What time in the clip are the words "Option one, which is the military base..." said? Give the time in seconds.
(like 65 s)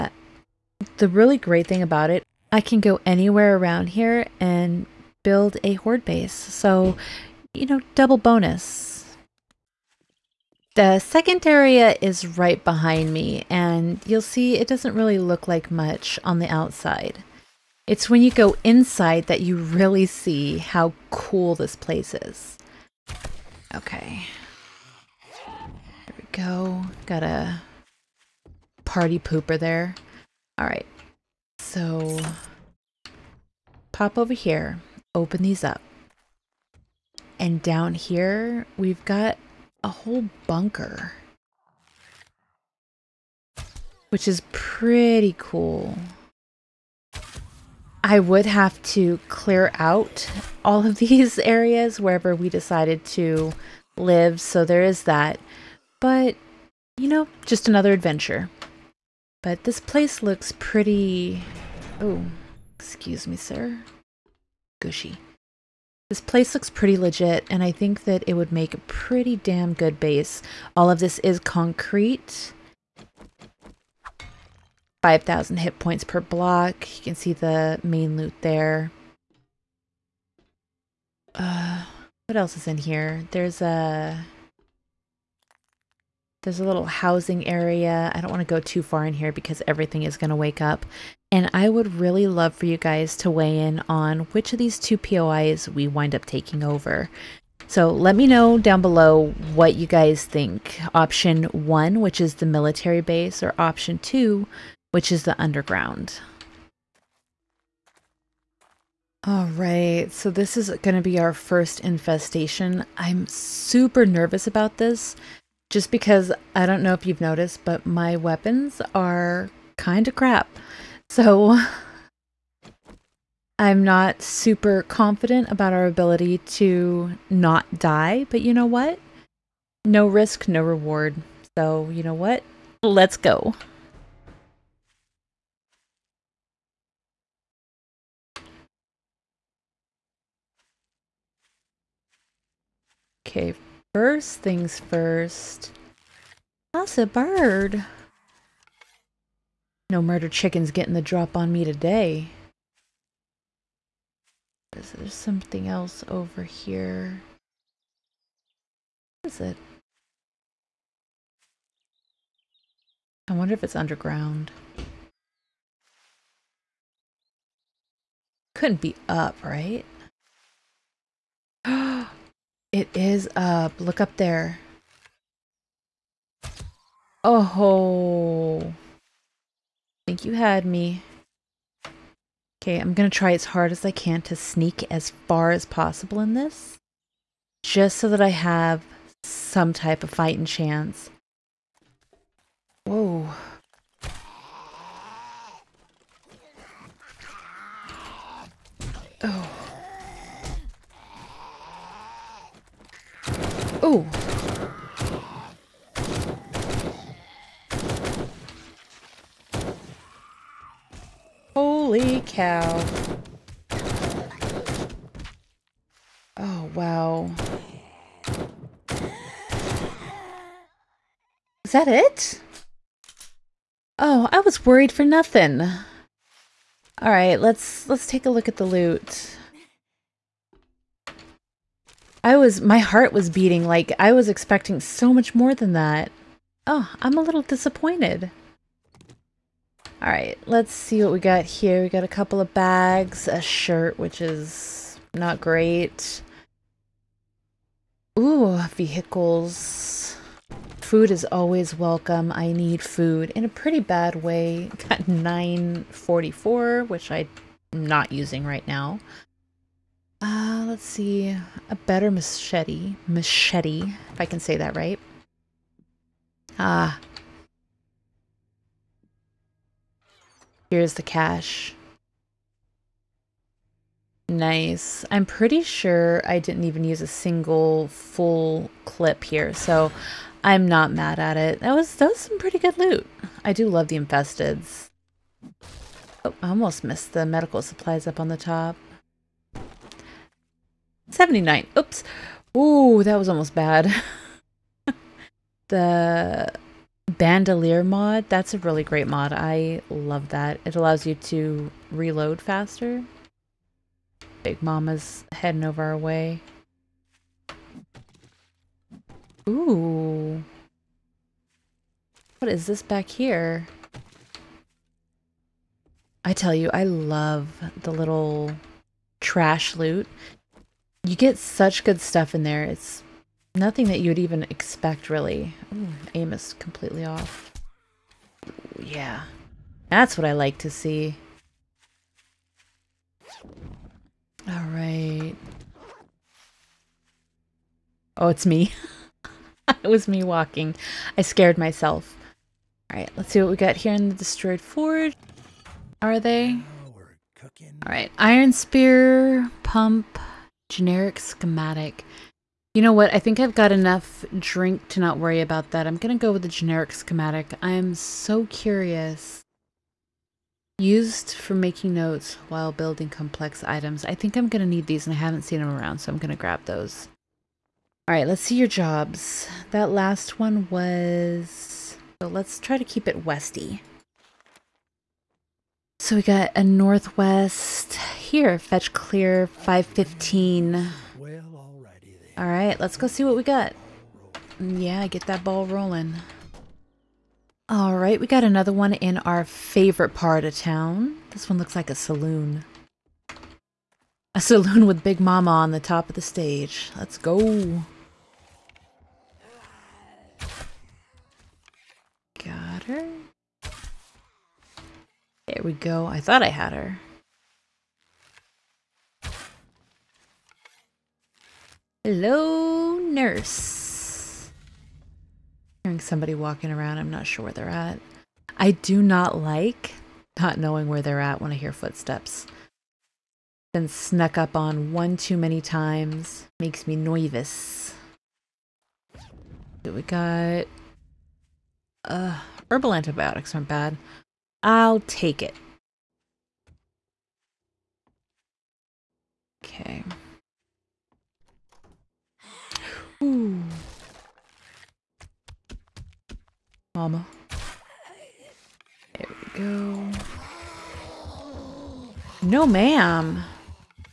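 100 s.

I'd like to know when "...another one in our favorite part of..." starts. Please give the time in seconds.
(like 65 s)
388 s.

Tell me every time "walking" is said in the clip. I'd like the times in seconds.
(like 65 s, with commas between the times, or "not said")
340 s, 416 s.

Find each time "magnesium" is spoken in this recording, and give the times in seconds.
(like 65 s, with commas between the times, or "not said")
not said.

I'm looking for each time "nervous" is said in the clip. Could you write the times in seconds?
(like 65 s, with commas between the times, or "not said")
114 s, 426 s.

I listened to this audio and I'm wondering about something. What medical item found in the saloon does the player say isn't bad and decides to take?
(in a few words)
Herbal antibiotics.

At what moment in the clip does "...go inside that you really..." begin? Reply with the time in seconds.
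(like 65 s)
18 s.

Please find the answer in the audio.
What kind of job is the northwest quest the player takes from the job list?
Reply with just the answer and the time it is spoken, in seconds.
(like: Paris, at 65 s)
Fetch clear, at 378 s.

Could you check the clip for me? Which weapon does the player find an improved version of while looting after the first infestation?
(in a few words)
Machete.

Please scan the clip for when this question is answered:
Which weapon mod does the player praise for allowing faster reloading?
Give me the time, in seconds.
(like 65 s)
295 s.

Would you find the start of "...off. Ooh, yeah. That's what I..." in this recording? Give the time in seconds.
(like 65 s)
327 s.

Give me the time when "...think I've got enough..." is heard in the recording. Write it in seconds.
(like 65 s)
353 s.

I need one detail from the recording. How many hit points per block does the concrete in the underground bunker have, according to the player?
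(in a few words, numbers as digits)
5,000.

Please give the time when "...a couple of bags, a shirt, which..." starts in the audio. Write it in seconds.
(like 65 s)
242 s.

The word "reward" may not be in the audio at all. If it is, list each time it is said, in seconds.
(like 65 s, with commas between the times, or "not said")
130 s.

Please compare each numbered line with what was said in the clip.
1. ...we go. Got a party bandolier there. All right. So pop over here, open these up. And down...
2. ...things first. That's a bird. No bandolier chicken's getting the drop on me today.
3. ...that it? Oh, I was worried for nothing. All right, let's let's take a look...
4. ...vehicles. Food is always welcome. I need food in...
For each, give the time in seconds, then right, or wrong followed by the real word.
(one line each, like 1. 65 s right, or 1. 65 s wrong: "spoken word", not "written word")
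1. 26 s wrong: "pooper", not "bandolier"
2. 144 s wrong: "murder", not "bandolier"
3. 221 s right
4. 248 s right.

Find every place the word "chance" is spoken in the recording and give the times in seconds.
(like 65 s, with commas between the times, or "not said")
190 s.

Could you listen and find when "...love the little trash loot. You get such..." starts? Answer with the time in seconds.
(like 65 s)
316 s.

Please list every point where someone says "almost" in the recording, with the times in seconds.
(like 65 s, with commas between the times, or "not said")
286 s, 293 s.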